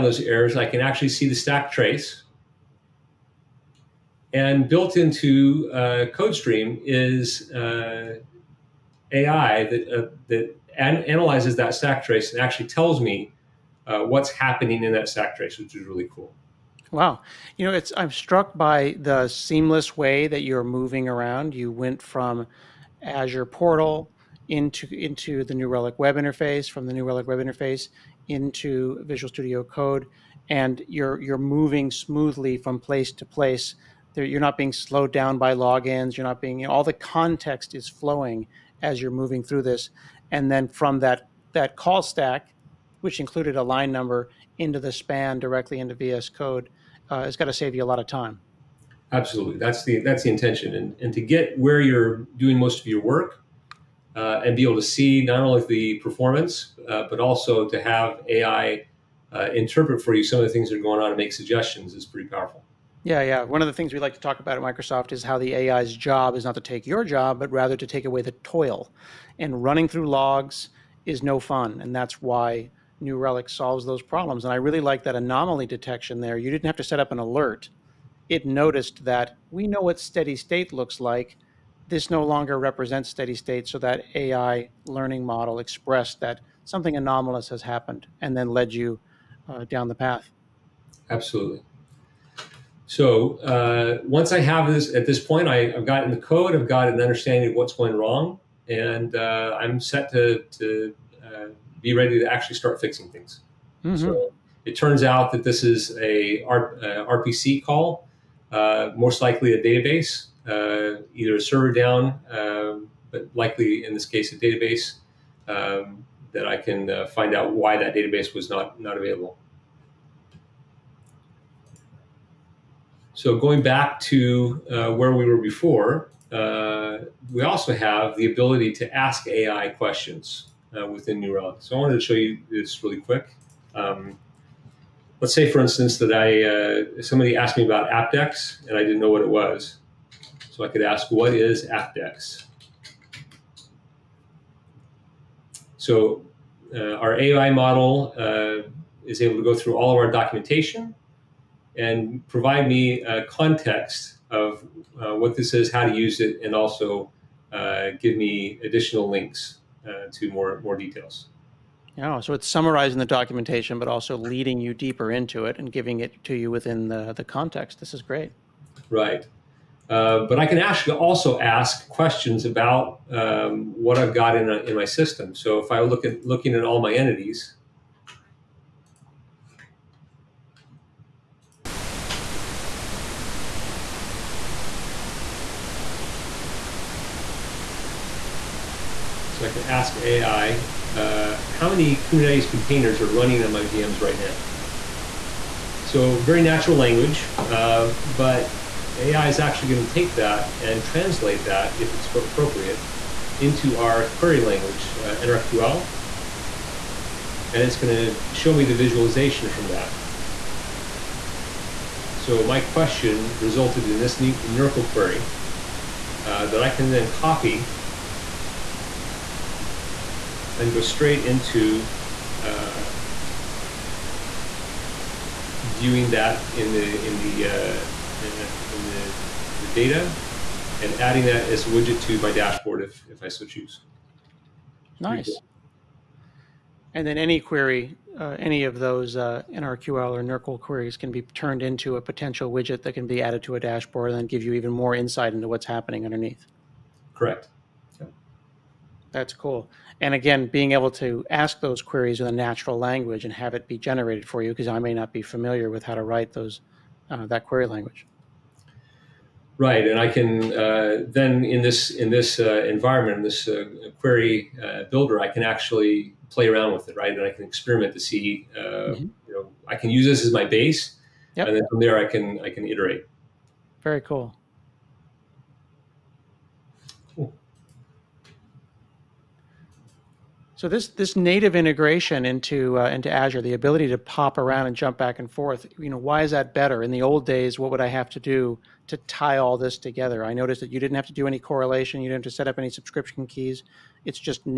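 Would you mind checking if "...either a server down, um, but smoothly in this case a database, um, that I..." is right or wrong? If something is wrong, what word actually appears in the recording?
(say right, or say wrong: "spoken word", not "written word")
wrong: "likely", not "smoothly".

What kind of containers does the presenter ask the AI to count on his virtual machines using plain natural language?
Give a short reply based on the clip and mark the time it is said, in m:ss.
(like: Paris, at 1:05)
Kubernetes containers, at 3:12.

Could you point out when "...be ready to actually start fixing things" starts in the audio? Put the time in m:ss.
1:41.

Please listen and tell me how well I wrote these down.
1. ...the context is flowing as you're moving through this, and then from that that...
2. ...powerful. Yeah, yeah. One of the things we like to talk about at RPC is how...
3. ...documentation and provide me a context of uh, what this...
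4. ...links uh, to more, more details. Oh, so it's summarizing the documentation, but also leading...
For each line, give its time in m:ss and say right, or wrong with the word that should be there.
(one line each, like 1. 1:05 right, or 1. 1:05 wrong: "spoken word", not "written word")
1. 0:36 right
2. 1:02 wrong: "Microsoft", not "RPC"
3. 2:30 right
4. 2:39 right.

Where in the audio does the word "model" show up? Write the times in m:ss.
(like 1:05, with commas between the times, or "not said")
1:25, 2:27.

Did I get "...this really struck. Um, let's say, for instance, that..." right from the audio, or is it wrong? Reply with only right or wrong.
wrong.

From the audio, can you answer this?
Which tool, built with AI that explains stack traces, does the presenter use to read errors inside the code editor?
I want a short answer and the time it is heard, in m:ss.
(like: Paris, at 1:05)
CodeStream, at 0:06.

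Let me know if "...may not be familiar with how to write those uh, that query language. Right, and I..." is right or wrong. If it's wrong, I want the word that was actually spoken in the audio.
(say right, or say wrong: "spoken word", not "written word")
right.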